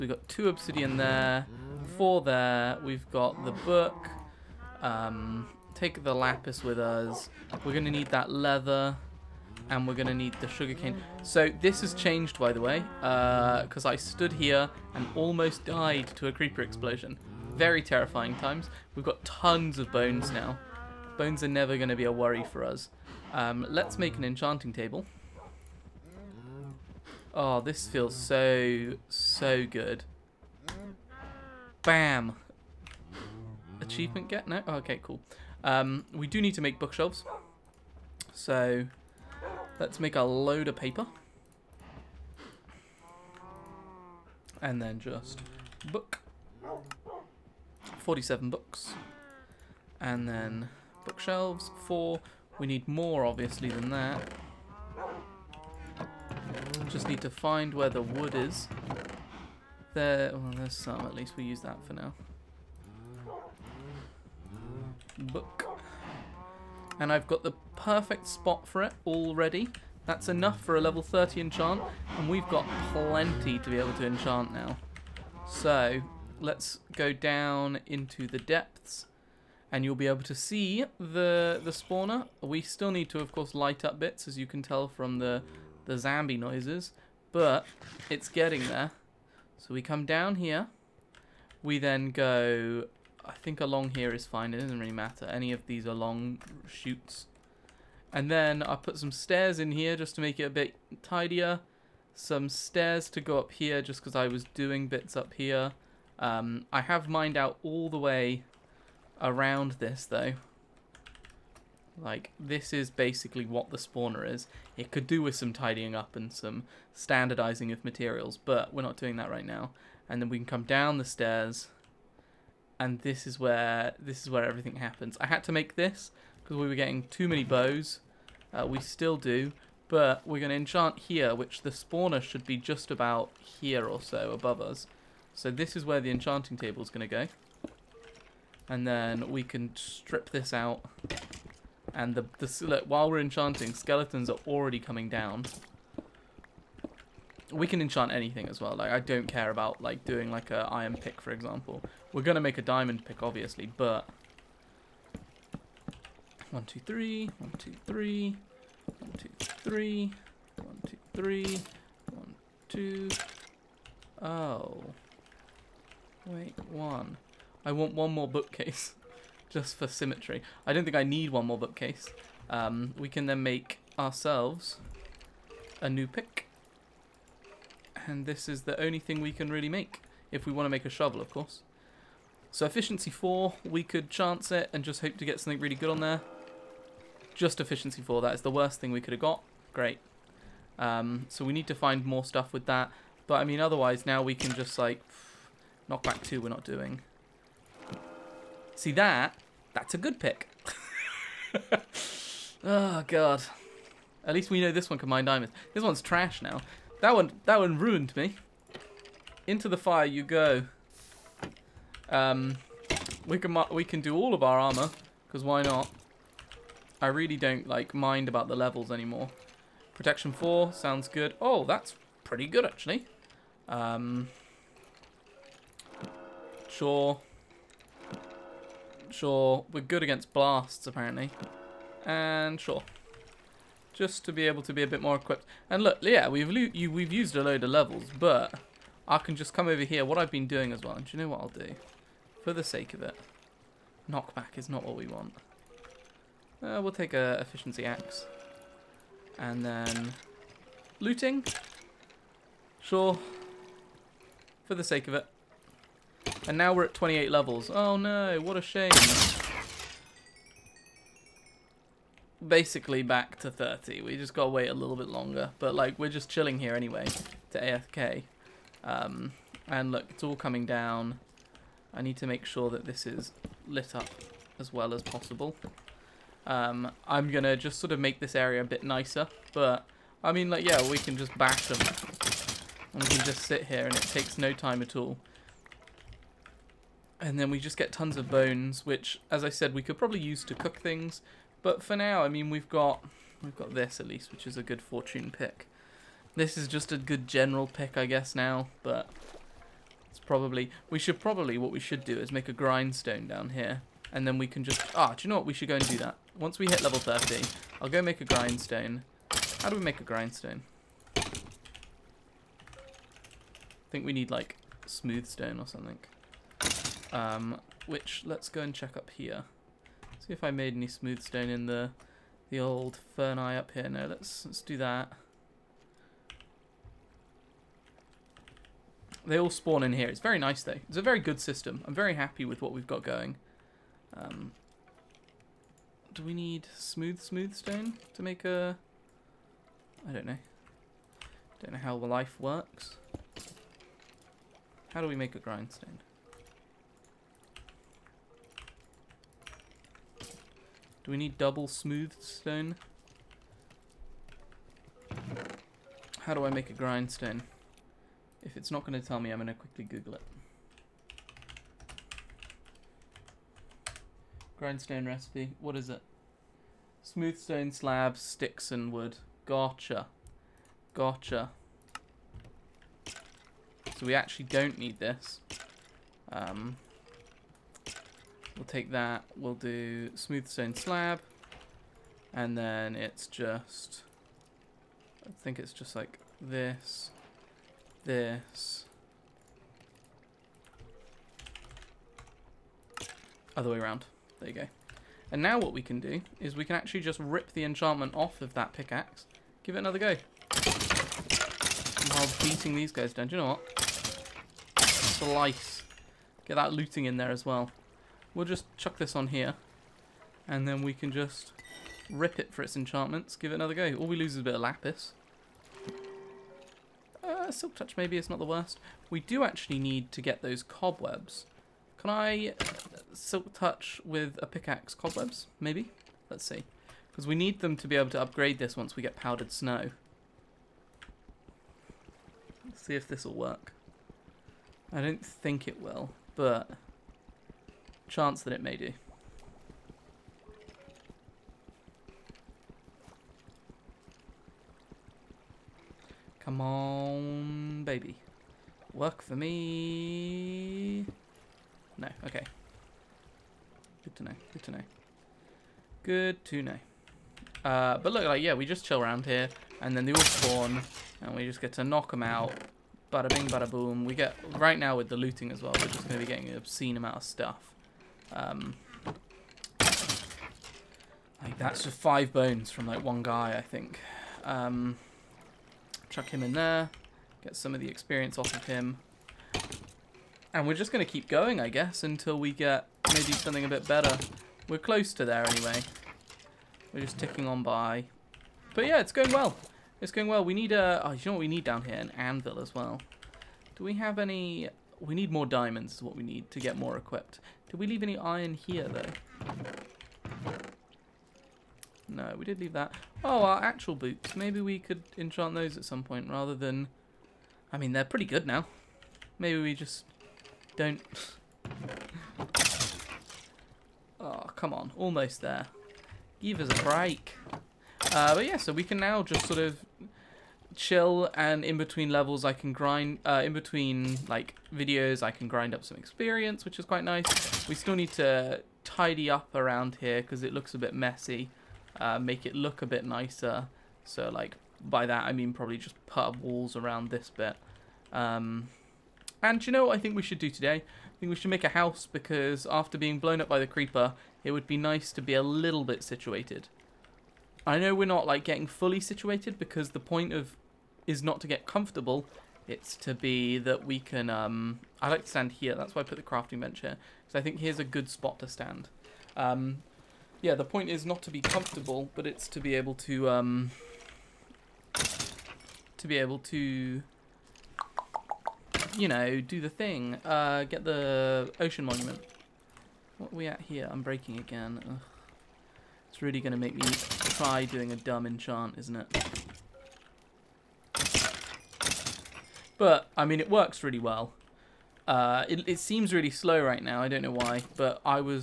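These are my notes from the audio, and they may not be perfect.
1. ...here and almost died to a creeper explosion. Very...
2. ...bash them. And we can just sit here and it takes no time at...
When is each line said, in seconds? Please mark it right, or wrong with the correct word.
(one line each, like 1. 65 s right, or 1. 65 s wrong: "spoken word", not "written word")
1. 14 s right
2. 281 s right.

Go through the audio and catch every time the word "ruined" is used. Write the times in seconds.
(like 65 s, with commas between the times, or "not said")
207 s.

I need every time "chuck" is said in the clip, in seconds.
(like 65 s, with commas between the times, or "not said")
408 s, 476 s.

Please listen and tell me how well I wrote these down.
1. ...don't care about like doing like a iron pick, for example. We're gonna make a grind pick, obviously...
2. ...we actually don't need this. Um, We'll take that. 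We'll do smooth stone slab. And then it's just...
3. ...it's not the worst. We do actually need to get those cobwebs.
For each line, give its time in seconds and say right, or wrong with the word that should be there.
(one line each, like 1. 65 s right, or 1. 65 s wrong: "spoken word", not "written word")
1. 148 s wrong: "diamond", not "grind"
2. 374 s right
3. 418 s right.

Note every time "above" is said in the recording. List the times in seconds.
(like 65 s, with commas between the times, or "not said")
134 s.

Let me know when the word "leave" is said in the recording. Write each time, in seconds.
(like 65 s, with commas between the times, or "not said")
497 s, 502 s.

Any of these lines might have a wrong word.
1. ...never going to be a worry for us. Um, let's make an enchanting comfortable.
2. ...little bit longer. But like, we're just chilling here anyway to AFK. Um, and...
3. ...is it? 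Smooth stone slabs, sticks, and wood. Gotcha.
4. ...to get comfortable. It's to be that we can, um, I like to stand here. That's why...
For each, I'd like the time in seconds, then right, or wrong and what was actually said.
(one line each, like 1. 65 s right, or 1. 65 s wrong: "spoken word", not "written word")
1. 21 s wrong: "table", not "comfortable"
2. 264 s right
3. 365 s right
4. 551 s right.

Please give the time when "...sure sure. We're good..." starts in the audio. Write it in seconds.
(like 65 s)
226 s.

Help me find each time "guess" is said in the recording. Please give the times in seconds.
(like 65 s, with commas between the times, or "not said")
298 s, 481 s.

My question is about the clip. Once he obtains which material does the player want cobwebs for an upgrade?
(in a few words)
Powdered snow.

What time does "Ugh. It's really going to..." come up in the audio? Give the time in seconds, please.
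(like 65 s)
574 s.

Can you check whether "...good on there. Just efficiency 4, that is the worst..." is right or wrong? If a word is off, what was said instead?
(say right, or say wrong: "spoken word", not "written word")
right.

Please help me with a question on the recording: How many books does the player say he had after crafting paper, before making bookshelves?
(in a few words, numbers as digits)
47.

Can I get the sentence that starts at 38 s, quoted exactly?
So, let's make a load of paper.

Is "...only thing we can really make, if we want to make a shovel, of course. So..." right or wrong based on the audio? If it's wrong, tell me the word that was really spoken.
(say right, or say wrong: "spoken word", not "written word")
right.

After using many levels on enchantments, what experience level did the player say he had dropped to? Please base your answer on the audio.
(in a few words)
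28.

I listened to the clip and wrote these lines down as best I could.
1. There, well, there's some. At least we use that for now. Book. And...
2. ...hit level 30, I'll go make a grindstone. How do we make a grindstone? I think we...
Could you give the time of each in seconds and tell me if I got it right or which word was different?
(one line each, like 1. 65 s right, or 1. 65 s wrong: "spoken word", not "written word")
1. 59 s right
2. 306 s right.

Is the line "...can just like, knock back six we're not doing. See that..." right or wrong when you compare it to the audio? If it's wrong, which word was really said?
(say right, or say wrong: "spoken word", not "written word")
wrong: "two", not "six".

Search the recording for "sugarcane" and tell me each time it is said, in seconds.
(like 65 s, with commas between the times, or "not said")
10 s.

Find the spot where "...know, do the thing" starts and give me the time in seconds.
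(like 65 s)
569 s.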